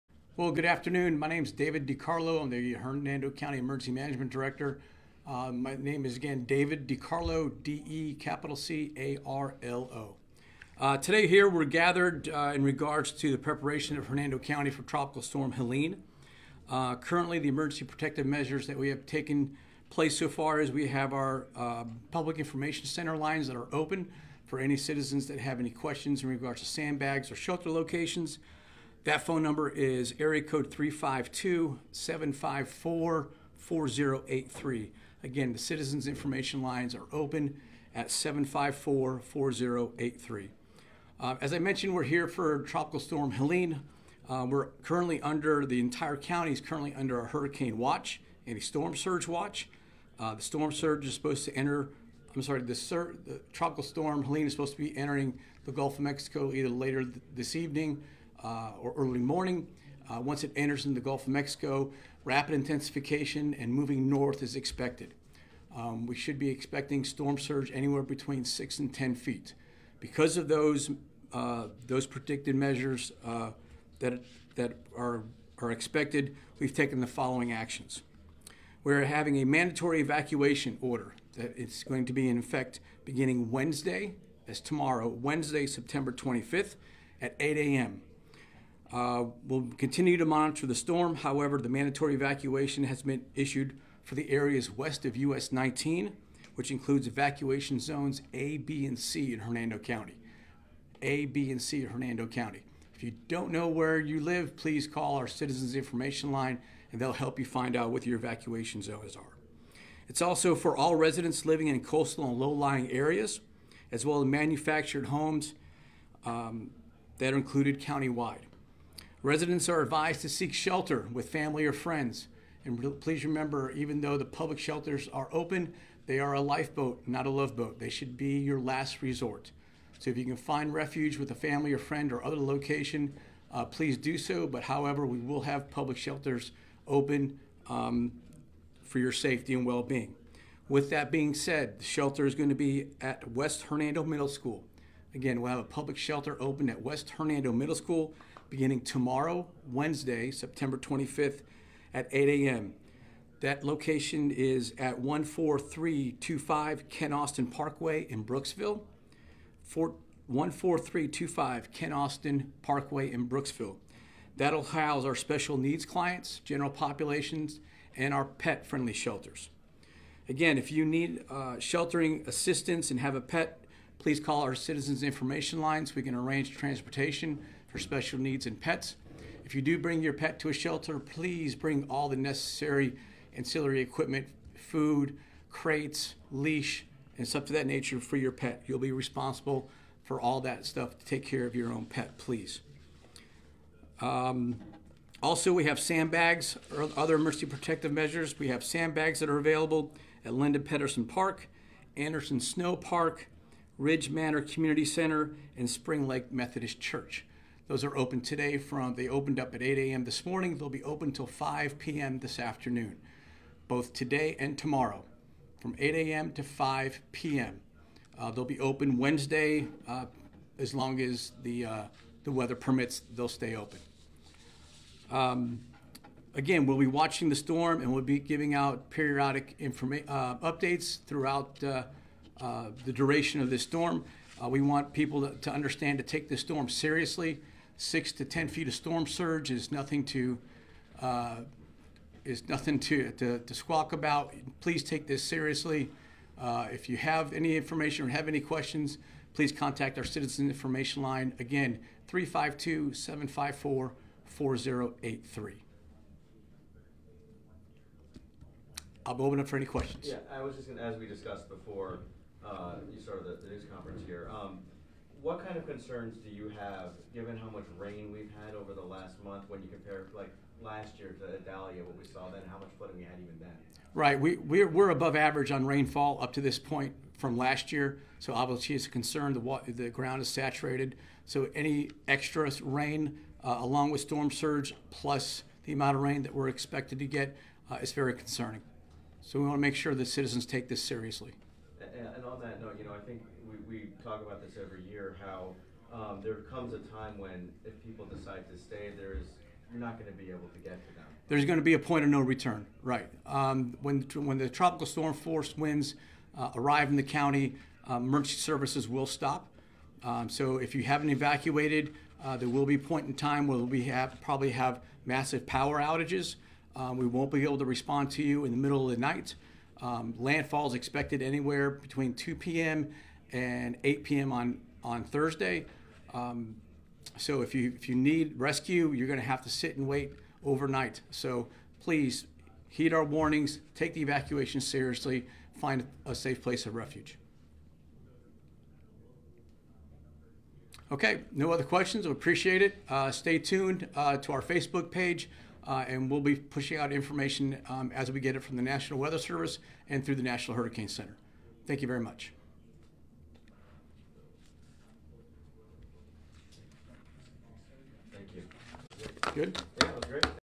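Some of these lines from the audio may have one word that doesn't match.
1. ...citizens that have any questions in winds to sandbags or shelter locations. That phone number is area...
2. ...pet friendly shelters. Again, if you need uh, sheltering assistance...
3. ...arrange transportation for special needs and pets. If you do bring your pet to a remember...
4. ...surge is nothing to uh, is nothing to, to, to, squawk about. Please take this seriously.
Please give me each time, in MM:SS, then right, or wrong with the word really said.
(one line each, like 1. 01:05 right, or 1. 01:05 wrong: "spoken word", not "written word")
1. 00:24 wrong: "regards", not "winds"
2. 02:48 right
3. 02:56 wrong: "shelter", not "remember"
4. 03:59 right.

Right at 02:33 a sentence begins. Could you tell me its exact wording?
That location is at 14325 Ken Austin Parkway in Brooksville.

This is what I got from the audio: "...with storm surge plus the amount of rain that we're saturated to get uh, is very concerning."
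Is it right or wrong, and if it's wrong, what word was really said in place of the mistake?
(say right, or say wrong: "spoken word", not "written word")
wrong: "expected", not "saturated".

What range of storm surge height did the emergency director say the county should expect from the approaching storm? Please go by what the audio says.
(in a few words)
6 to 10 feet.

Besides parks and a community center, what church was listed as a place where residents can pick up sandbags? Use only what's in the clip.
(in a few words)
Spring Lake Methodist Church.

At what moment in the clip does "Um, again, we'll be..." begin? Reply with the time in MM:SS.
03:45.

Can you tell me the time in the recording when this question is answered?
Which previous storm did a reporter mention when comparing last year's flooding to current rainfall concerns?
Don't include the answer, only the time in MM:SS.
04:31.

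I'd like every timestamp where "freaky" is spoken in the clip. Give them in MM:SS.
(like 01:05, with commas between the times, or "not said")
not said.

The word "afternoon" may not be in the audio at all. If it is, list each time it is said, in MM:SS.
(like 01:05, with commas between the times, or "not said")
00:00, 03:32.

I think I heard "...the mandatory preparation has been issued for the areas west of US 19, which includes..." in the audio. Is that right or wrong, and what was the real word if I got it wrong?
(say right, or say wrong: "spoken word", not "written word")
wrong: "evacuation", not "preparation".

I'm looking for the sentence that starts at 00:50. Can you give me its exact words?
Uh, the storm surge is supposed to enter.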